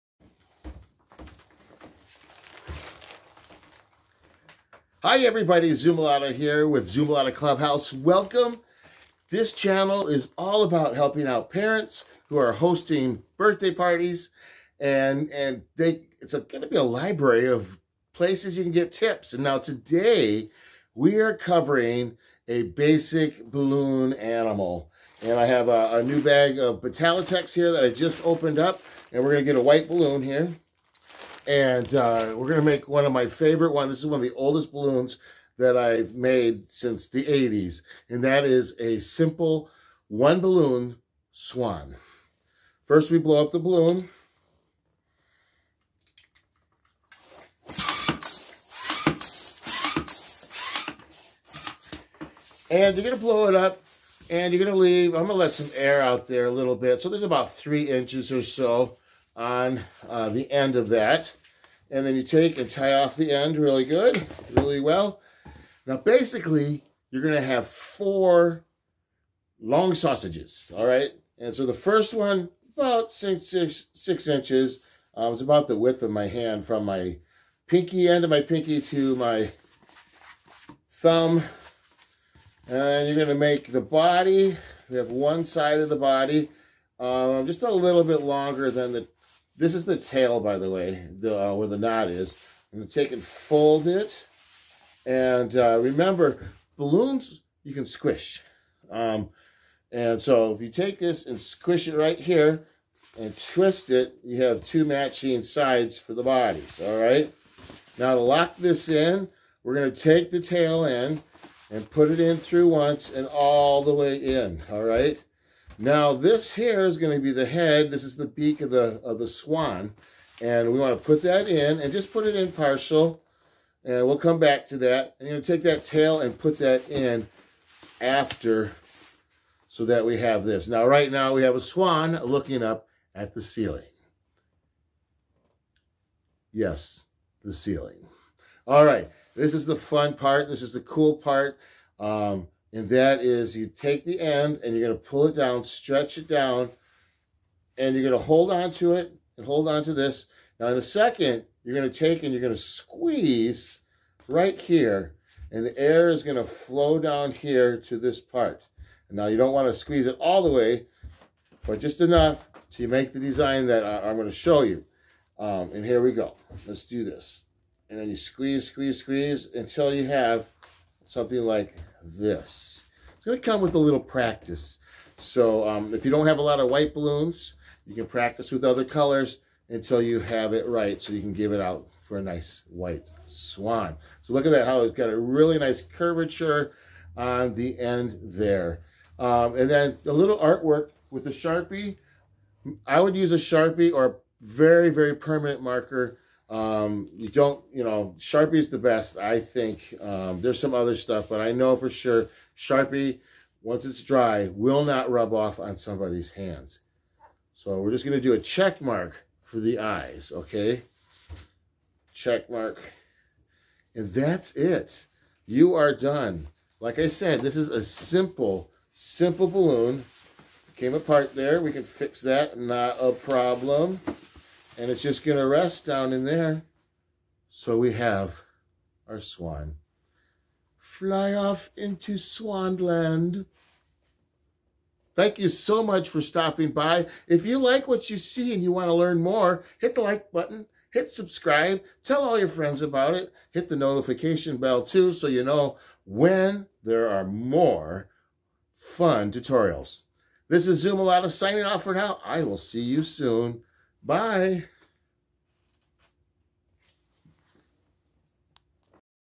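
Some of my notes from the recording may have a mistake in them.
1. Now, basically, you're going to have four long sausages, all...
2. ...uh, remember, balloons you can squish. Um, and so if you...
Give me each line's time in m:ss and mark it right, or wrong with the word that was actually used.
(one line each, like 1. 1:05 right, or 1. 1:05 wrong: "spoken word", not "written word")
1. 1:05 right
2. 1:35 right.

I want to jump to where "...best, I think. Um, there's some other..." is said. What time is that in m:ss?
3:18.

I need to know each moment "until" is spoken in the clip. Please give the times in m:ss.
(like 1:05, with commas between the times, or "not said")
2:49, 2:59.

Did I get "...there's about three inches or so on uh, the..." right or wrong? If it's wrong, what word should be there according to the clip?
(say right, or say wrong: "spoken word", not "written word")
right.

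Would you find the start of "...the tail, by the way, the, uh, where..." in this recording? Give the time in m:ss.
1:29.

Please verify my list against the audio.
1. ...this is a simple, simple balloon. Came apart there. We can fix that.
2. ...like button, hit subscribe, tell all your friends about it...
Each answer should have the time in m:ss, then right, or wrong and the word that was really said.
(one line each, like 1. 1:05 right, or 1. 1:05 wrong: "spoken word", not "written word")
1. 3:37 right
2. 4:00 right.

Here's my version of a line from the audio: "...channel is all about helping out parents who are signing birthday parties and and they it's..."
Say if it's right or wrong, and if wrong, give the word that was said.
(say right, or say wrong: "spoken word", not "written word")
wrong: "hosting", not "signing".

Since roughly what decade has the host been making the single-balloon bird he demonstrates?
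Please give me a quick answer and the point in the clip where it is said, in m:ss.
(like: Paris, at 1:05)
the 80s, at 0:37.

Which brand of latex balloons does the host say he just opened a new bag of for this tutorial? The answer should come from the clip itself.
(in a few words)
Betallatex.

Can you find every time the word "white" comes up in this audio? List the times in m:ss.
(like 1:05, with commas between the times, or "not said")
0:29, 2:56, 3:02.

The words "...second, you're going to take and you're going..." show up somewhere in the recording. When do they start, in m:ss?
2:30.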